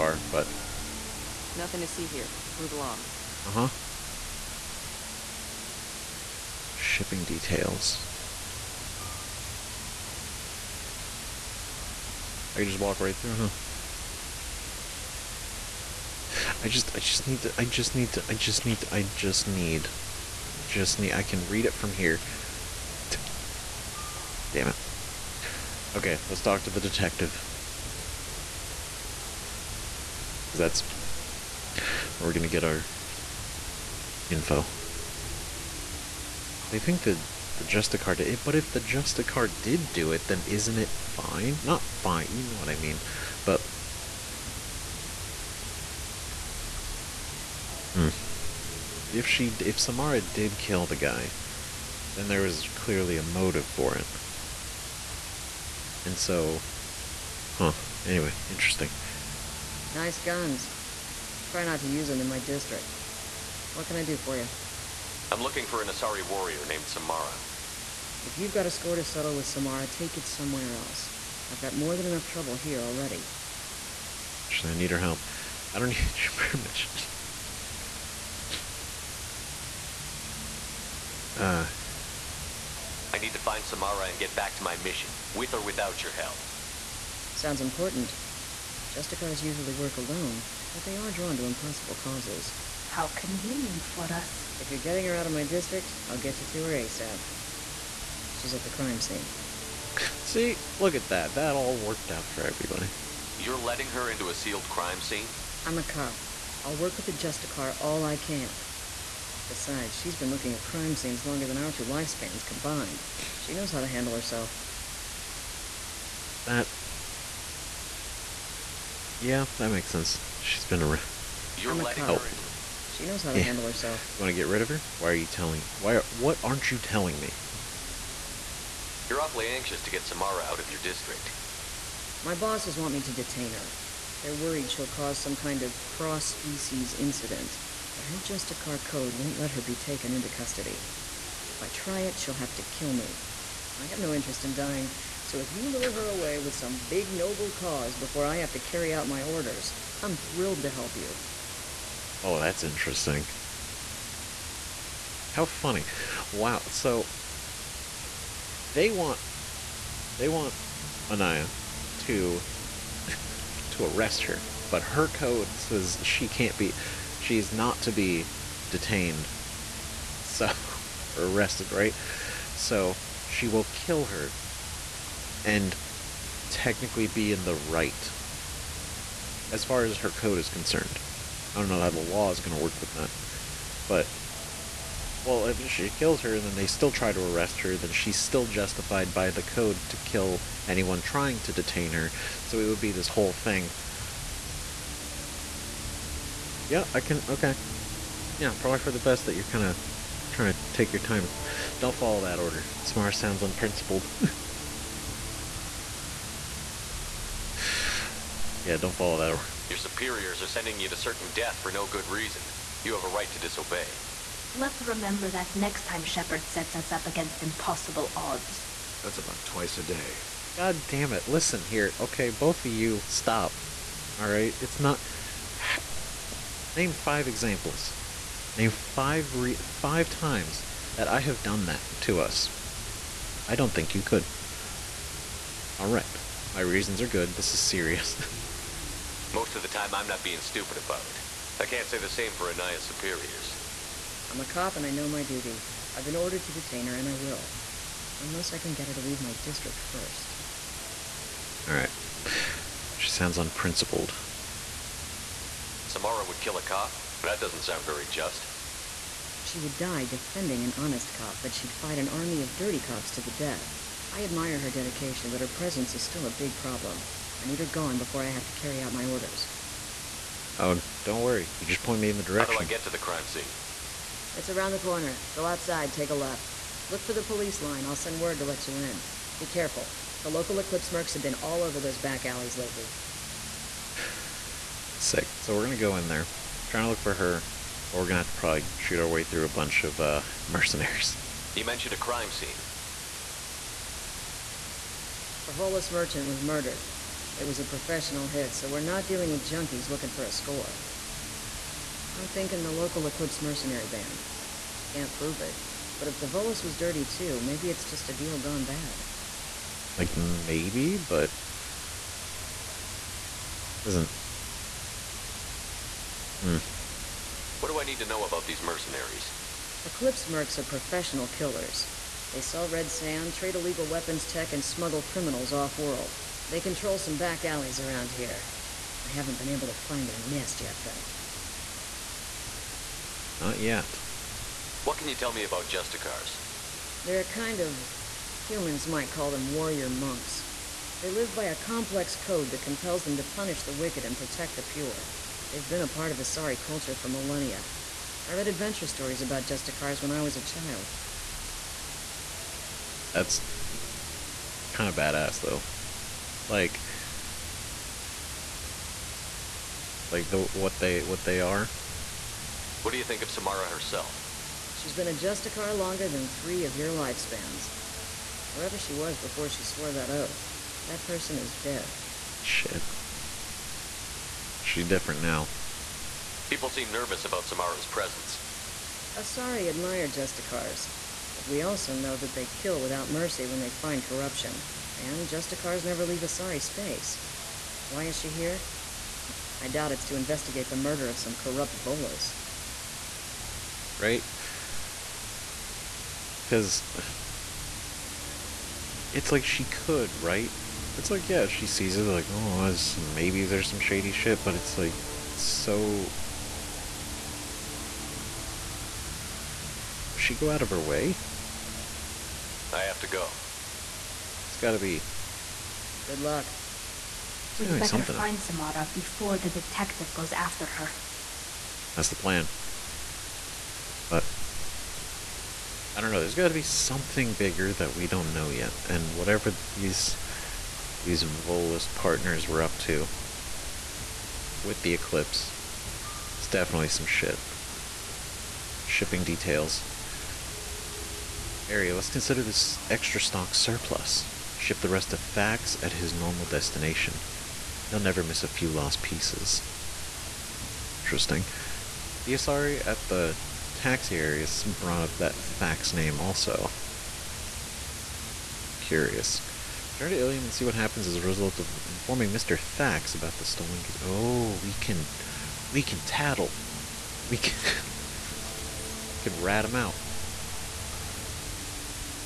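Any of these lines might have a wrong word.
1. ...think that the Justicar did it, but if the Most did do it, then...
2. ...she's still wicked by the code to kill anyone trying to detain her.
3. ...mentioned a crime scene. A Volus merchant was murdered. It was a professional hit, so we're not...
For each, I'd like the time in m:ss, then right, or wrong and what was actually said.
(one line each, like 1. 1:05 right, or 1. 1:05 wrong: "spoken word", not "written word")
1. 0:36 wrong: "Justicar", not "Most"
2. 3:07 wrong: "justified", not "wicked"
3. 4:51 right.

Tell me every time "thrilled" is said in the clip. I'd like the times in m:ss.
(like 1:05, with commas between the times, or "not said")
2:30.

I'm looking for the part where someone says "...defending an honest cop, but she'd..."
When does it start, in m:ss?
4:20.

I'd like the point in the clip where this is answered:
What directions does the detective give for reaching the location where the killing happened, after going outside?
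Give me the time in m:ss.
4:35.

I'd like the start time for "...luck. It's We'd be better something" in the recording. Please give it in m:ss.
6:56.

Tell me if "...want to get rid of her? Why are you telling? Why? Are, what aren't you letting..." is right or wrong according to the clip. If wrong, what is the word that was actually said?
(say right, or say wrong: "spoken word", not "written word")
wrong: "telling", not "letting".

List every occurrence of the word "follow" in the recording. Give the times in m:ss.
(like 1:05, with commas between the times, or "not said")
3:21, 3:28.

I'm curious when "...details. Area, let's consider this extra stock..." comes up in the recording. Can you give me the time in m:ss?
7:19.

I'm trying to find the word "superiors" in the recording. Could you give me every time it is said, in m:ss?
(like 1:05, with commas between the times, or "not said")
3:29, 4:02.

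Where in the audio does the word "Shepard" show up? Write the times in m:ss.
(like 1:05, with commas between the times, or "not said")
3:36.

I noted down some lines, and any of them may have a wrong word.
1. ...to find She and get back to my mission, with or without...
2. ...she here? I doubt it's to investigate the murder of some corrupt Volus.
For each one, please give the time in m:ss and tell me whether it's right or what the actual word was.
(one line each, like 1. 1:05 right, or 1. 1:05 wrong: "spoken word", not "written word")
1. 1:23 wrong: "Samara", not "She"
2. 6:28 right.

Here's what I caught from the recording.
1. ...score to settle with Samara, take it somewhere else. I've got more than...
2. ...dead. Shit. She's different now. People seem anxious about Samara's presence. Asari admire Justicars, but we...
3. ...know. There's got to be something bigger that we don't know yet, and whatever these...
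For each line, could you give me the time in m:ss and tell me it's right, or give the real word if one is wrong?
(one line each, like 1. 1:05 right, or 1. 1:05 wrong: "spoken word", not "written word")
1. 1:08 right
2. 6:11 wrong: "nervous", not "anxious"
3. 7:06 right.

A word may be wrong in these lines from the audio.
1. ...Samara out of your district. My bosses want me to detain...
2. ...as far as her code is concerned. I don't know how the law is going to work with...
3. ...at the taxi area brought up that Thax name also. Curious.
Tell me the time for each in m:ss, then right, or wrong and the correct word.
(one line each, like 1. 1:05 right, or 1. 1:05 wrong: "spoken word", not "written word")
1. 2:10 right
2. 2:59 right
3. 7:32 right.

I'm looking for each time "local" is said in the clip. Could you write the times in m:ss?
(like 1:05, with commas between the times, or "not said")
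4:40, 5:02.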